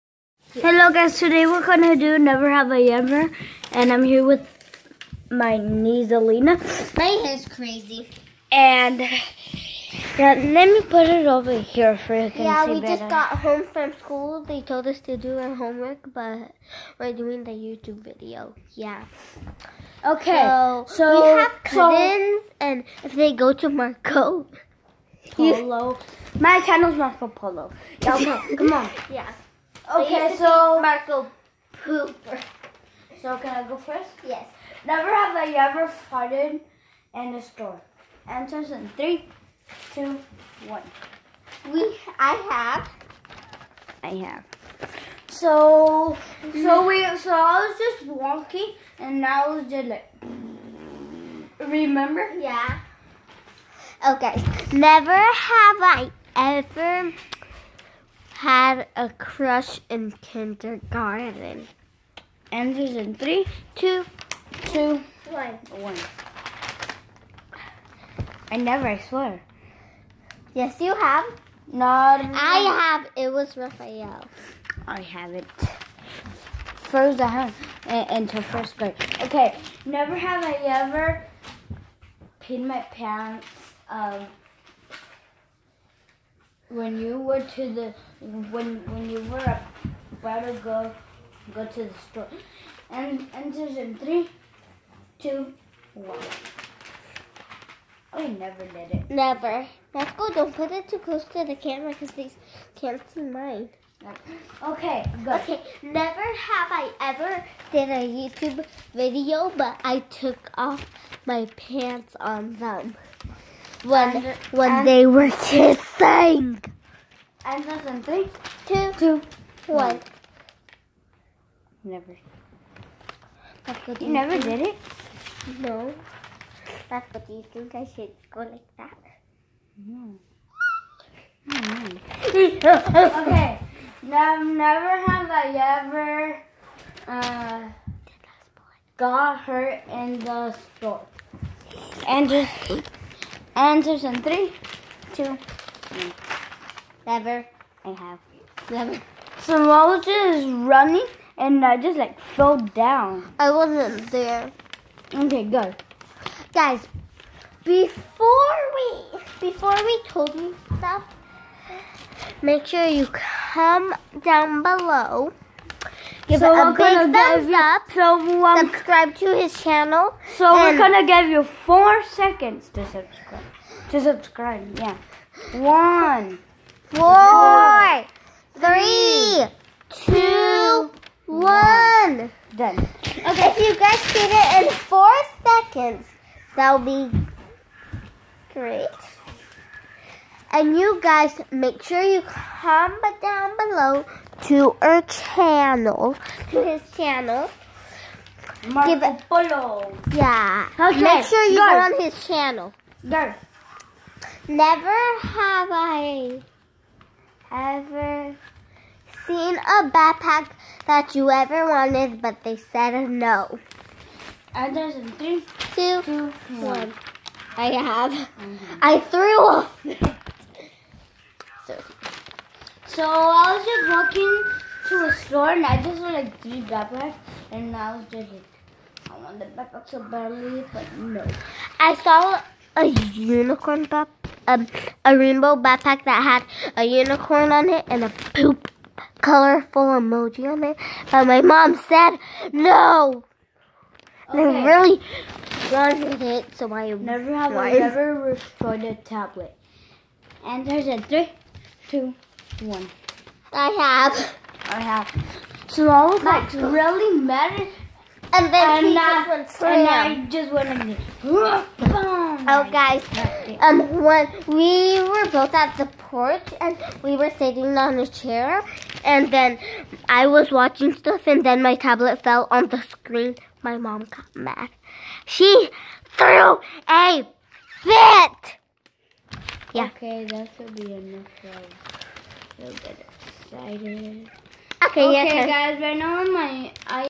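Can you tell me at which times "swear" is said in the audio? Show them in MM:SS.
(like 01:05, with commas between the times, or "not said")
01:08.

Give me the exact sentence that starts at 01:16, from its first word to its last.
First, I have until uh, first grade.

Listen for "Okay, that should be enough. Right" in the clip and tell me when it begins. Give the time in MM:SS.
04:39.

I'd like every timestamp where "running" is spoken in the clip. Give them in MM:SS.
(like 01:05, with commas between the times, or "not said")
02:30.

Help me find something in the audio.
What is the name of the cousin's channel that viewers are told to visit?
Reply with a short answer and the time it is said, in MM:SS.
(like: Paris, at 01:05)
Marco Polo, at 00:26.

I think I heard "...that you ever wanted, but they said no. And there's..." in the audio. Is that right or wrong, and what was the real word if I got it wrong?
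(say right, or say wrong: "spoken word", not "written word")
right.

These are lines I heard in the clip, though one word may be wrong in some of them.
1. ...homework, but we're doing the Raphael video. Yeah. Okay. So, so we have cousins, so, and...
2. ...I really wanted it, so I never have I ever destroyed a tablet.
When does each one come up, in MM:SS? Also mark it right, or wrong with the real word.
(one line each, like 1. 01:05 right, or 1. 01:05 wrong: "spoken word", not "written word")
1. 00:15 wrong: "YouTube", not "Raphael"
2. 04:04 right.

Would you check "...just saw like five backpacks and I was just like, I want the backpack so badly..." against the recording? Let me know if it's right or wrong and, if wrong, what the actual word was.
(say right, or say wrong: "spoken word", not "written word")
wrong: "three", not "five".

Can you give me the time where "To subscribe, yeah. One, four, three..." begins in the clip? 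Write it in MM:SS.
02:53.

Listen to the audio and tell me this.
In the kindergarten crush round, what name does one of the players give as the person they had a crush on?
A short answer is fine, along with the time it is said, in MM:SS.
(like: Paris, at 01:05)
Raphael, at 01:13.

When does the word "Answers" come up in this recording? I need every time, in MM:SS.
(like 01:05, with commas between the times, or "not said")
00:38, 01:02, 02:23.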